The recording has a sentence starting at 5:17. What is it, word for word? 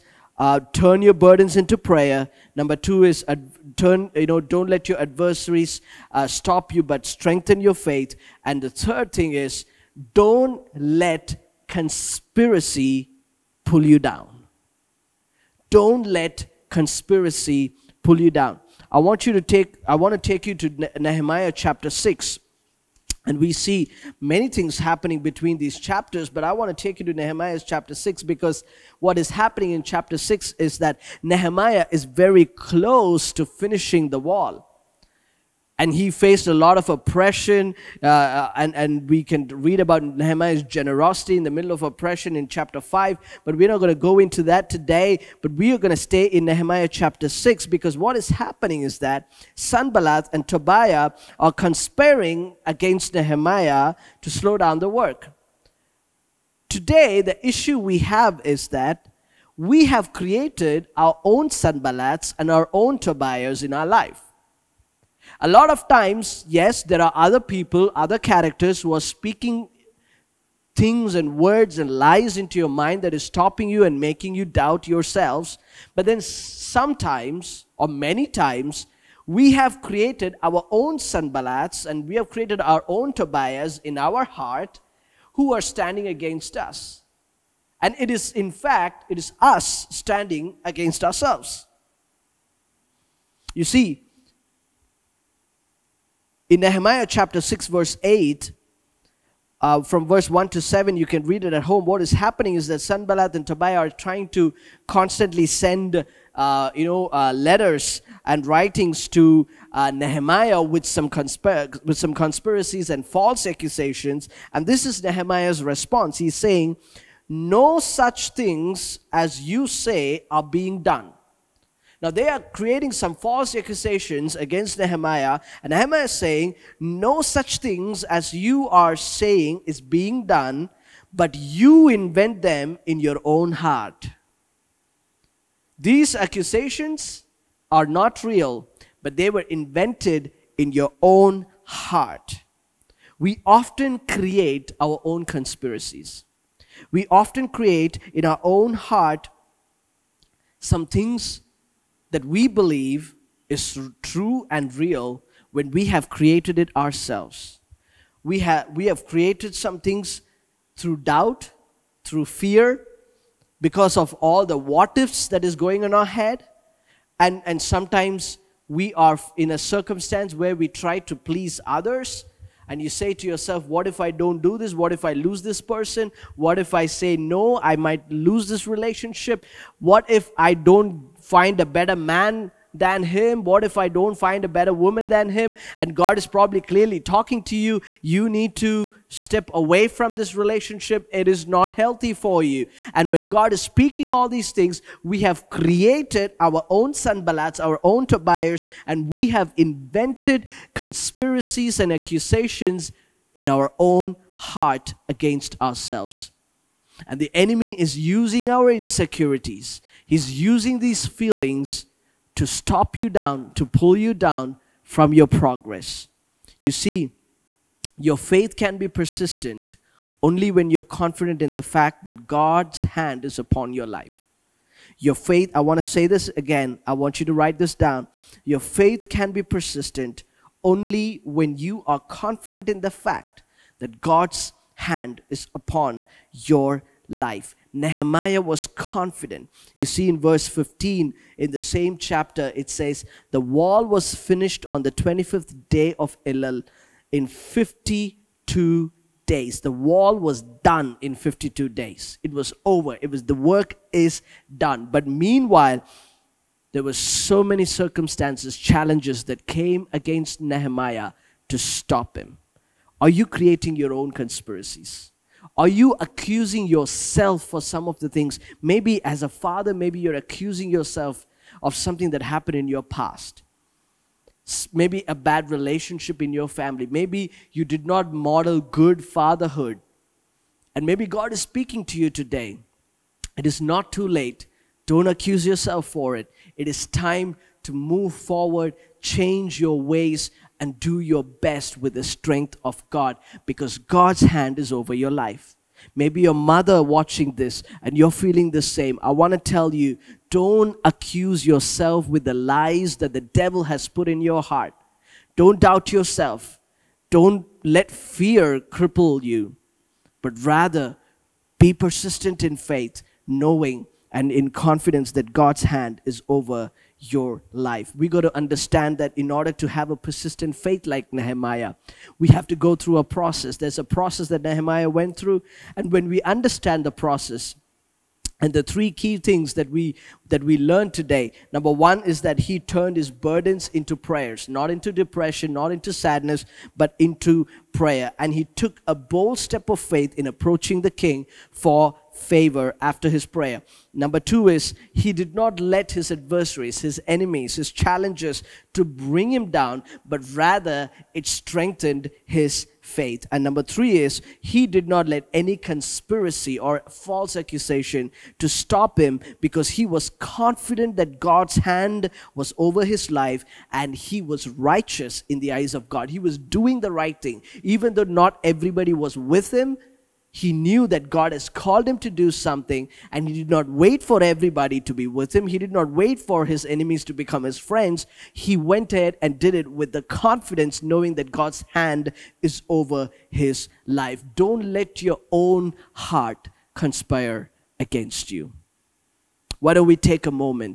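We got to understand that in order to have a persistent faith like Nehemiah, we have to go through a process.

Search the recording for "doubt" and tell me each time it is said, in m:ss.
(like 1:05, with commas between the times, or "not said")
1:14, 2:41, 5:05.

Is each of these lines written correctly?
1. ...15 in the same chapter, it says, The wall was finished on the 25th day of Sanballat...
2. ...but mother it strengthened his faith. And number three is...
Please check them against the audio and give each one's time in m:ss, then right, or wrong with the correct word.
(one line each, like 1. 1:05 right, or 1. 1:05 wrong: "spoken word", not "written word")
1. 4:00 wrong: "Elul", not "Sanballat"
2. 5:50 wrong: "rather", not "mother".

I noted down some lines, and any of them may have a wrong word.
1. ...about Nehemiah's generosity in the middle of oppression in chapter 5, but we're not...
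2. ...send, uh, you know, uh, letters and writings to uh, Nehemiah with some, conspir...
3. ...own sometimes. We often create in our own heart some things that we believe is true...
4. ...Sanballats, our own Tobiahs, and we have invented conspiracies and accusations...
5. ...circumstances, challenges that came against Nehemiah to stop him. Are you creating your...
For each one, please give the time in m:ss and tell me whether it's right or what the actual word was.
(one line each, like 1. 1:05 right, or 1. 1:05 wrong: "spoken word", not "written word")
1. 0:39 right
2. 1:45 right
3. 2:25 wrong: "conspiracies", not "sometimes"
4. 3:16 right
5. 4:17 right.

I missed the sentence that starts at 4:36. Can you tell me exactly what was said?
Maybe you did not model good fatherhood.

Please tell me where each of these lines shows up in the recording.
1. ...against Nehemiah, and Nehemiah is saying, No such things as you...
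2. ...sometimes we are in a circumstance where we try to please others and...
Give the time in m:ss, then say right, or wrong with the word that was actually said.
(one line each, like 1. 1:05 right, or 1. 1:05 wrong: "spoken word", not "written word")
1. 2:04 right
2. 2:47 right.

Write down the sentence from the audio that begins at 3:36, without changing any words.
You see, your faith can be persistent only when you're confident in the fact that God's hand is upon your life.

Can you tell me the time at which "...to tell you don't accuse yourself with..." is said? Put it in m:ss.
4:59.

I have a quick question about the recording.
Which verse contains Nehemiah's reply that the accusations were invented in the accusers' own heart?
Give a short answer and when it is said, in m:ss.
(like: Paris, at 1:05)
Verse 8, at 1:37.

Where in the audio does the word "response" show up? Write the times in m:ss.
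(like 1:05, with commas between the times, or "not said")
1:55.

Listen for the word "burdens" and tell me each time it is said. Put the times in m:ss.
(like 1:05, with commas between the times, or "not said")
0:01, 5:33.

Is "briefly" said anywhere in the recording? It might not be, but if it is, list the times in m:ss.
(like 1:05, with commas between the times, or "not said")
not said.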